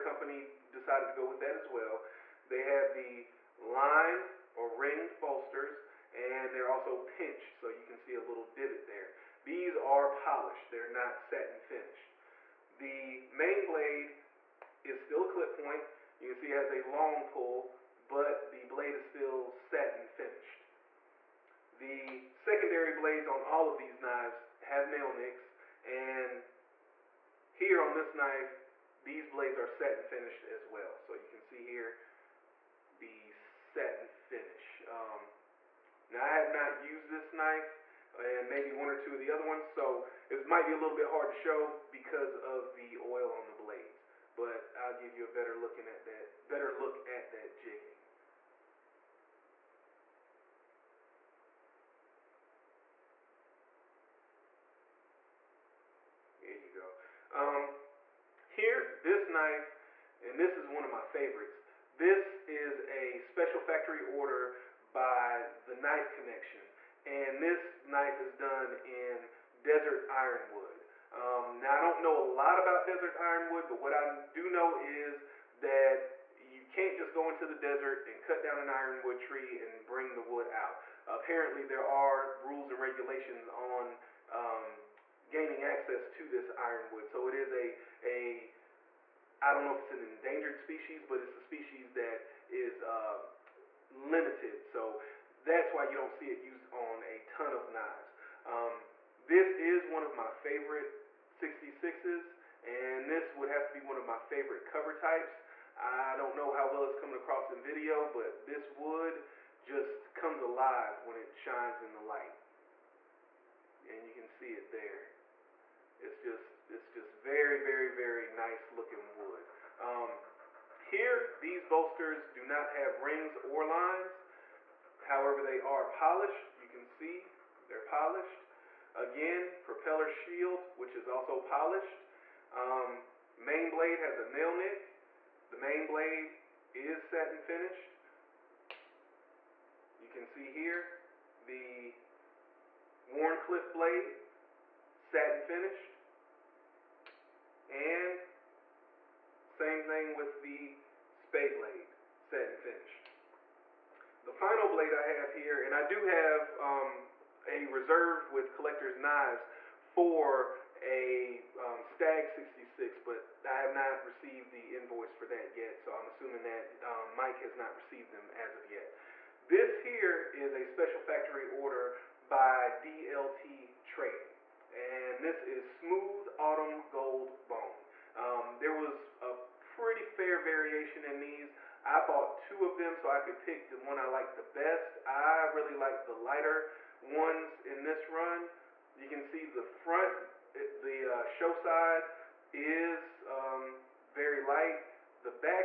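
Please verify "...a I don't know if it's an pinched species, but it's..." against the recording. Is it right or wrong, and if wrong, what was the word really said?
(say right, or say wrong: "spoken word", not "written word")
wrong: "endangered", not "pinched".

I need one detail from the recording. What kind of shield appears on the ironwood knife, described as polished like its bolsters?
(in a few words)
Propeller shield.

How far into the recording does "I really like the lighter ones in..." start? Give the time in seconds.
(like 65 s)
185 s.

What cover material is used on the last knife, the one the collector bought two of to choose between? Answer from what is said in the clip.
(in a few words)
Smooth Autumn Gold Bone.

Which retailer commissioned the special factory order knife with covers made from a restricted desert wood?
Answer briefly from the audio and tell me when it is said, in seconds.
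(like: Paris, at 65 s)
The Knife Connection, at 65 s.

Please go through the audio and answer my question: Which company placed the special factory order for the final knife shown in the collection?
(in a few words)
DLT Trading.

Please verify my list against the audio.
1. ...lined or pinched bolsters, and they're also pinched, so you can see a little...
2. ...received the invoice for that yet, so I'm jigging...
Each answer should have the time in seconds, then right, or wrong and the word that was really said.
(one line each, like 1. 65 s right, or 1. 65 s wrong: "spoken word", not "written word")
1. 3 s wrong: "ringed", not "pinched"
2. 164 s wrong: "assuming", not "jigging".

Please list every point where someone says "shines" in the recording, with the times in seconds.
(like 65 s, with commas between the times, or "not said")
111 s.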